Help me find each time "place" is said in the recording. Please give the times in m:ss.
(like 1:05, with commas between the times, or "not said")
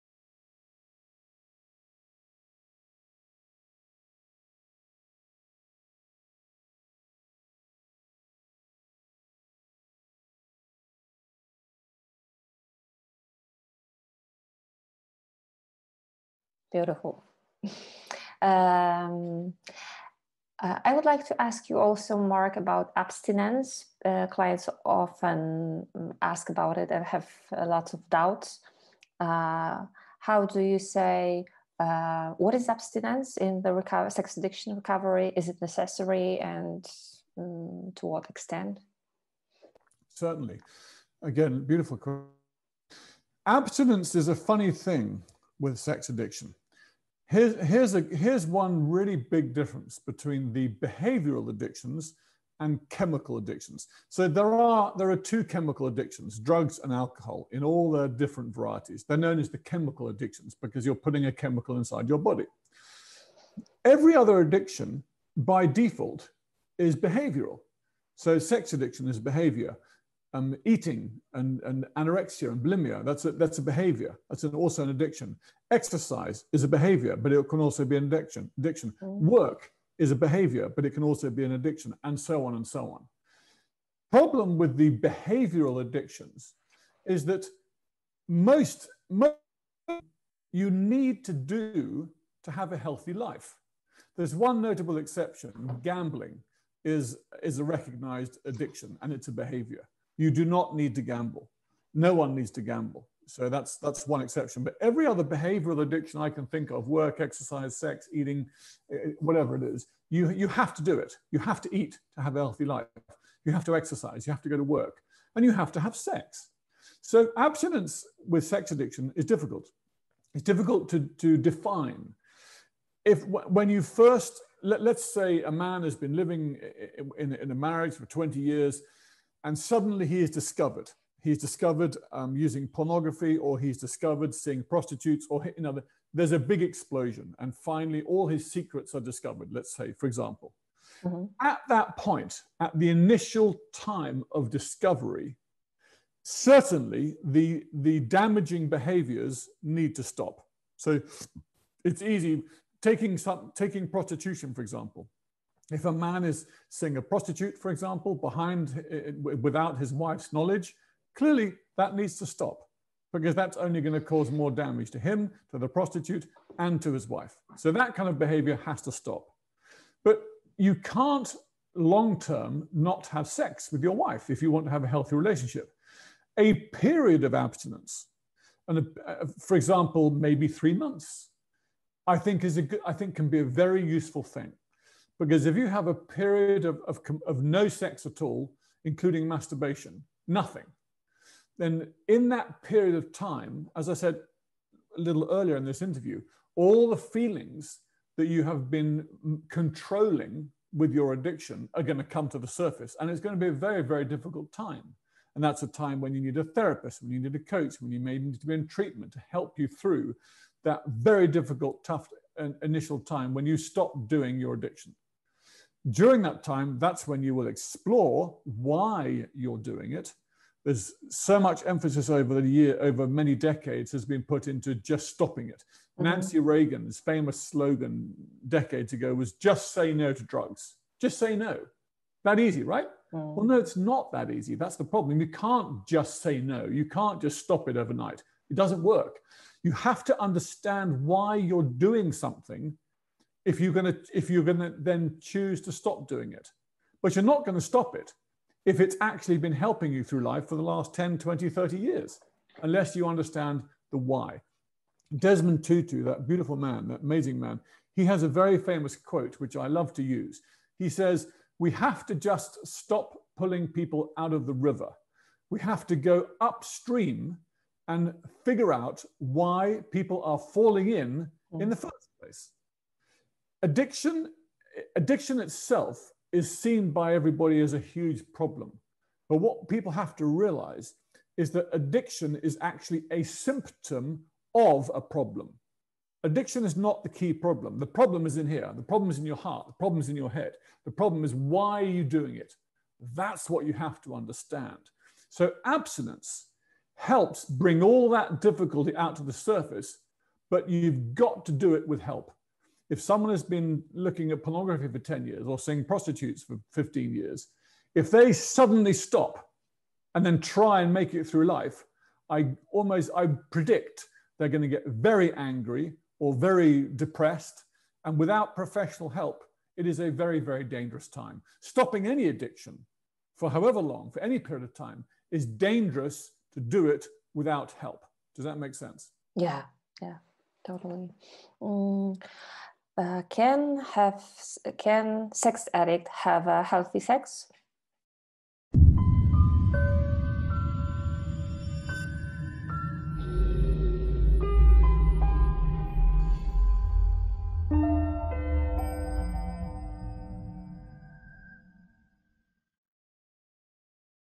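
4:32.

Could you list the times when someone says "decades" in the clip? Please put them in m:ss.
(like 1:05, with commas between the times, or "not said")
3:43, 3:48.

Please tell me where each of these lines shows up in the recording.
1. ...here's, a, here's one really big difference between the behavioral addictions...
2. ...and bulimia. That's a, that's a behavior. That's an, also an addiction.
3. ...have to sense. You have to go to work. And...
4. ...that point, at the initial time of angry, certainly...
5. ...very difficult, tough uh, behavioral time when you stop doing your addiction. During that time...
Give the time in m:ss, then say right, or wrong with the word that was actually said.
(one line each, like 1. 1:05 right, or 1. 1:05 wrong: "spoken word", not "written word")
1. 0:47 right
2. 1:12 right
3. 1:53 wrong: "exercise", not "sense"
4. 2:21 wrong: "discovery", not "angry"
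5. 3:30 wrong: "initial", not "behavioral".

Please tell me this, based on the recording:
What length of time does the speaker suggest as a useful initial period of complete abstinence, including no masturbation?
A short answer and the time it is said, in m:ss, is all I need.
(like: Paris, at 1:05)
3 months, at 3:00.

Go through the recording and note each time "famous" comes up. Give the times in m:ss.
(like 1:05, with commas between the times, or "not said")
3:46, 4:18.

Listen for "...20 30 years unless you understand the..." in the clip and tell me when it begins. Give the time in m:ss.
4:11.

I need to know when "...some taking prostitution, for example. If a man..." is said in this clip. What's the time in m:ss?
2:33.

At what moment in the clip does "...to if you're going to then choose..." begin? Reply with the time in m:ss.
4:03.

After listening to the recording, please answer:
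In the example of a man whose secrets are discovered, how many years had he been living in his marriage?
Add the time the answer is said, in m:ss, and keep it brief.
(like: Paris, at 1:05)
20, at 2:08.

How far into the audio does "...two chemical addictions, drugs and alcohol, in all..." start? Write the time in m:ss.
0:55.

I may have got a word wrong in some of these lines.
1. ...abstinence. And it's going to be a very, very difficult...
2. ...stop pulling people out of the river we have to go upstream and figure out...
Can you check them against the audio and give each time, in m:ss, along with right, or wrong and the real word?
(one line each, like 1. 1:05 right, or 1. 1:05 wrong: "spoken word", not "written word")
1. 3:22 wrong: "surface", not "abstinence"
2. 4:22 right.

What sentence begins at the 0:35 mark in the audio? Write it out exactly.
Is it necessary and um, to what extent?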